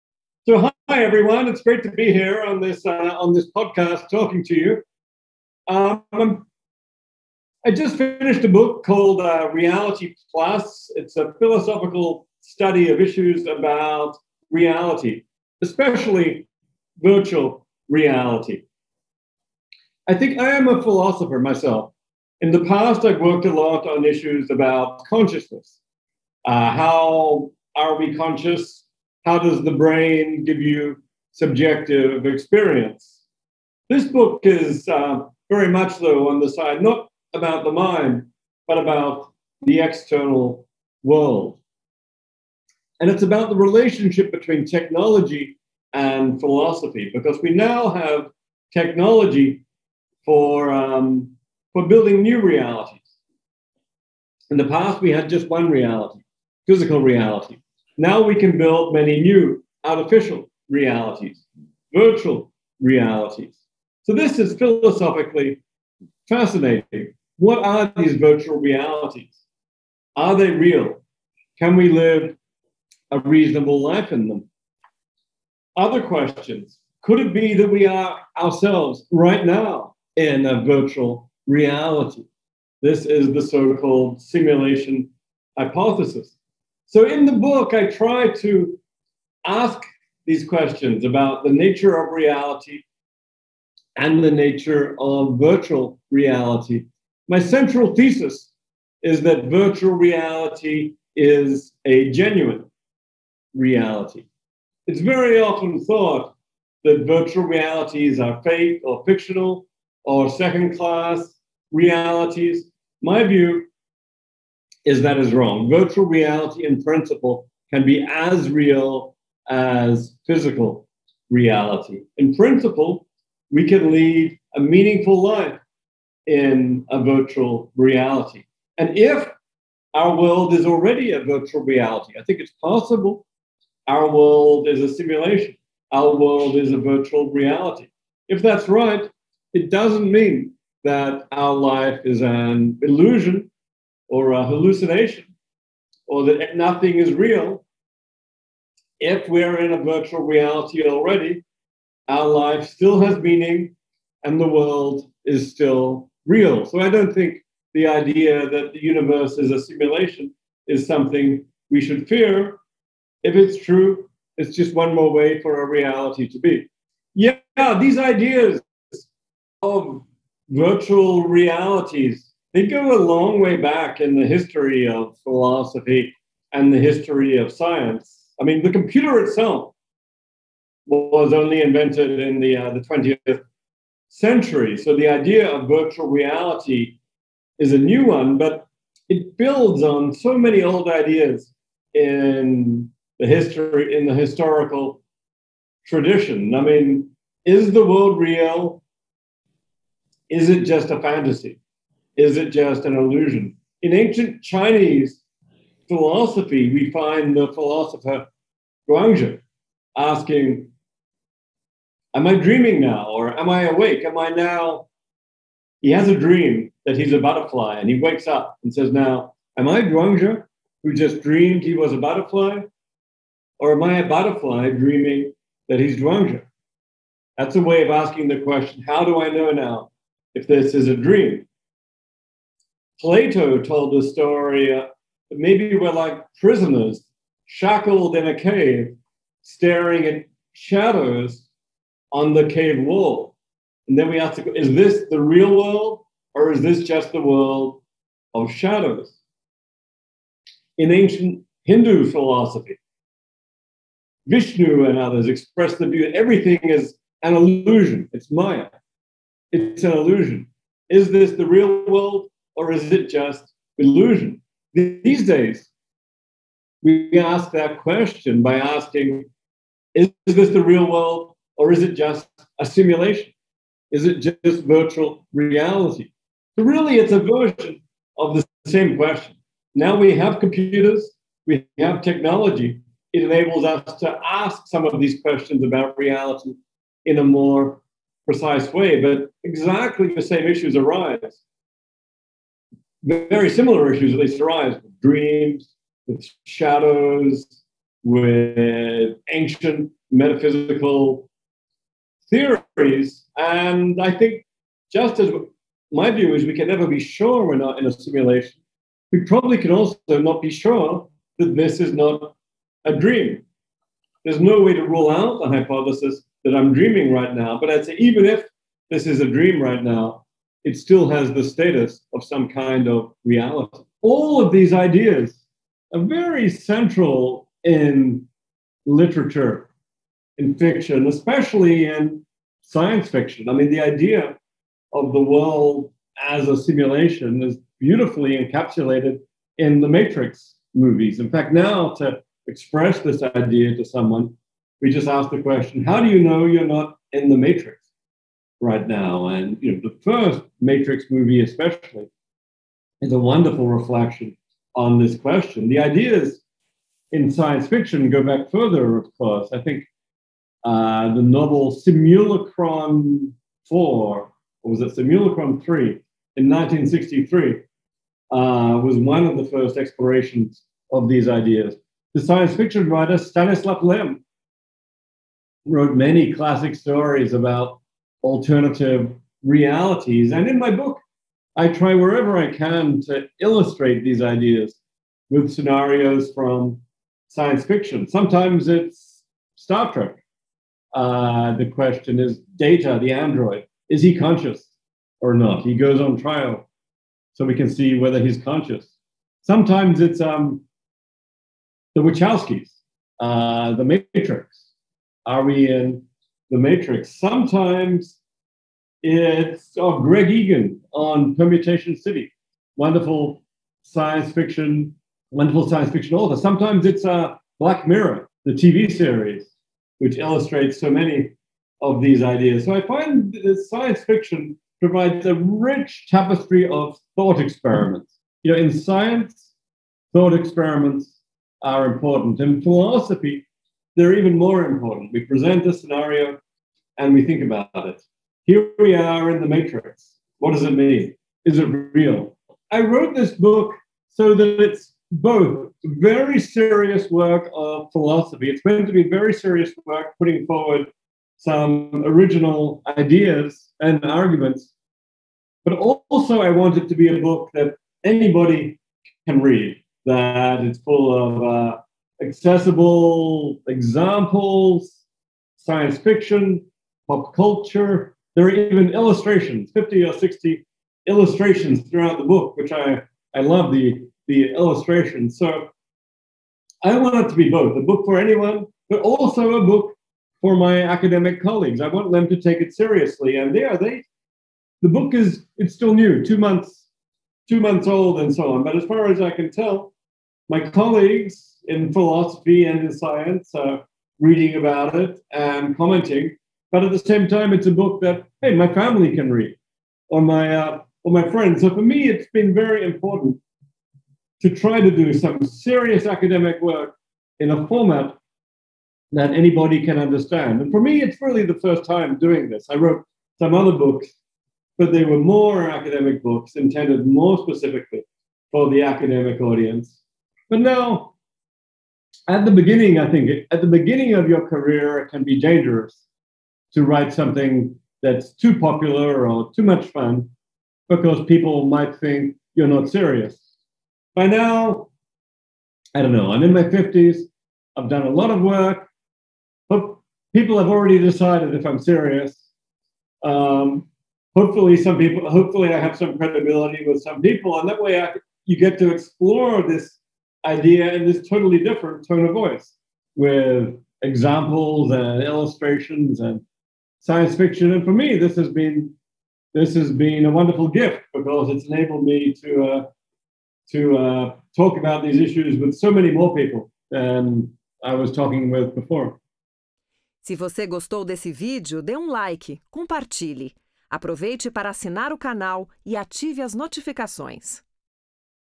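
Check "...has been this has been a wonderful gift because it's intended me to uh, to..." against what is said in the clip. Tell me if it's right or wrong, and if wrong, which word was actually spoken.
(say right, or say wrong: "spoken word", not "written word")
wrong: "enabled", not "intended".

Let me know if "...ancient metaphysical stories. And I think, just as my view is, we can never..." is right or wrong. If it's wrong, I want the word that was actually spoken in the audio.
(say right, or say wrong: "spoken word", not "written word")
wrong: "theories", not "stories".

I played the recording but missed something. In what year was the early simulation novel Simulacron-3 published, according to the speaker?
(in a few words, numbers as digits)
1963.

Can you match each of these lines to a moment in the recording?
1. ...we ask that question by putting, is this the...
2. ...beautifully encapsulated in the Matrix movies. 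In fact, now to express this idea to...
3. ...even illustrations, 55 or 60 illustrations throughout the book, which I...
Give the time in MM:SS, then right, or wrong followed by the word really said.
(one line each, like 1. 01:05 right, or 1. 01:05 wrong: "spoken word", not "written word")
1. 04:26 wrong: "asking", not "putting"
2. 05:37 right
3. 07:48 wrong: "50", not "55".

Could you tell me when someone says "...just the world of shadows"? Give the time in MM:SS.
04:06.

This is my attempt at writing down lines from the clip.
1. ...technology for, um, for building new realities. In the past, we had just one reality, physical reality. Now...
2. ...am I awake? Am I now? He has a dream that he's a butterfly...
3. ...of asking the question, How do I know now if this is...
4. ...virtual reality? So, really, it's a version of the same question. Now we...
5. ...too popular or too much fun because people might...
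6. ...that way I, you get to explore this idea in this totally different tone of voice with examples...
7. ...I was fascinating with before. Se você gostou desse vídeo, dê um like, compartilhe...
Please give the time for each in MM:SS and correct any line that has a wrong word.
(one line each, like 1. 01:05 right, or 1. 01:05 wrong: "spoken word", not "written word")
1. 00:48 right
2. 03:33 right
3. 03:47 right
4. 04:34 right
5. 08:48 right
6. 09:07 right
7. 09:27 wrong: "talking", not "fascinating".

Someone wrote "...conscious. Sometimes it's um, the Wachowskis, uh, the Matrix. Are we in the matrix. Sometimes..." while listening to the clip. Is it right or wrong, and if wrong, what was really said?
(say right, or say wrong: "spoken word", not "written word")
right.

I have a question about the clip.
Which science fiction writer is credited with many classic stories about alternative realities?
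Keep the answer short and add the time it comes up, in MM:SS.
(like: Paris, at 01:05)
Stanislav Lem, at 06:13.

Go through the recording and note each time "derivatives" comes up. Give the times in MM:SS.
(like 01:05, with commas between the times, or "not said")
not said.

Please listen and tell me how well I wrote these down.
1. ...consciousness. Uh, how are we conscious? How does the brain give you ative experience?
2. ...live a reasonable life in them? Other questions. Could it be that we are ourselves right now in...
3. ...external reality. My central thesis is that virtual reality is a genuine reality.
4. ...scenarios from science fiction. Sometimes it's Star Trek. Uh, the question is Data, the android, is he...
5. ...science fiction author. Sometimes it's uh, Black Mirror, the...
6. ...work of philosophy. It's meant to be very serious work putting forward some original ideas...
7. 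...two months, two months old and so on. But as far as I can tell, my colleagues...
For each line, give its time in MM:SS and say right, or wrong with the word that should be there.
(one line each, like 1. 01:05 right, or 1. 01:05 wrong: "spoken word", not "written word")
1. 00:25 wrong: "subjective", not "ative"
2. 01:11 right
3. 01:35 wrong: "virtual", not "external"
4. 06:25 right
5. 06:55 right
6. 07:27 right
7. 08:06 right.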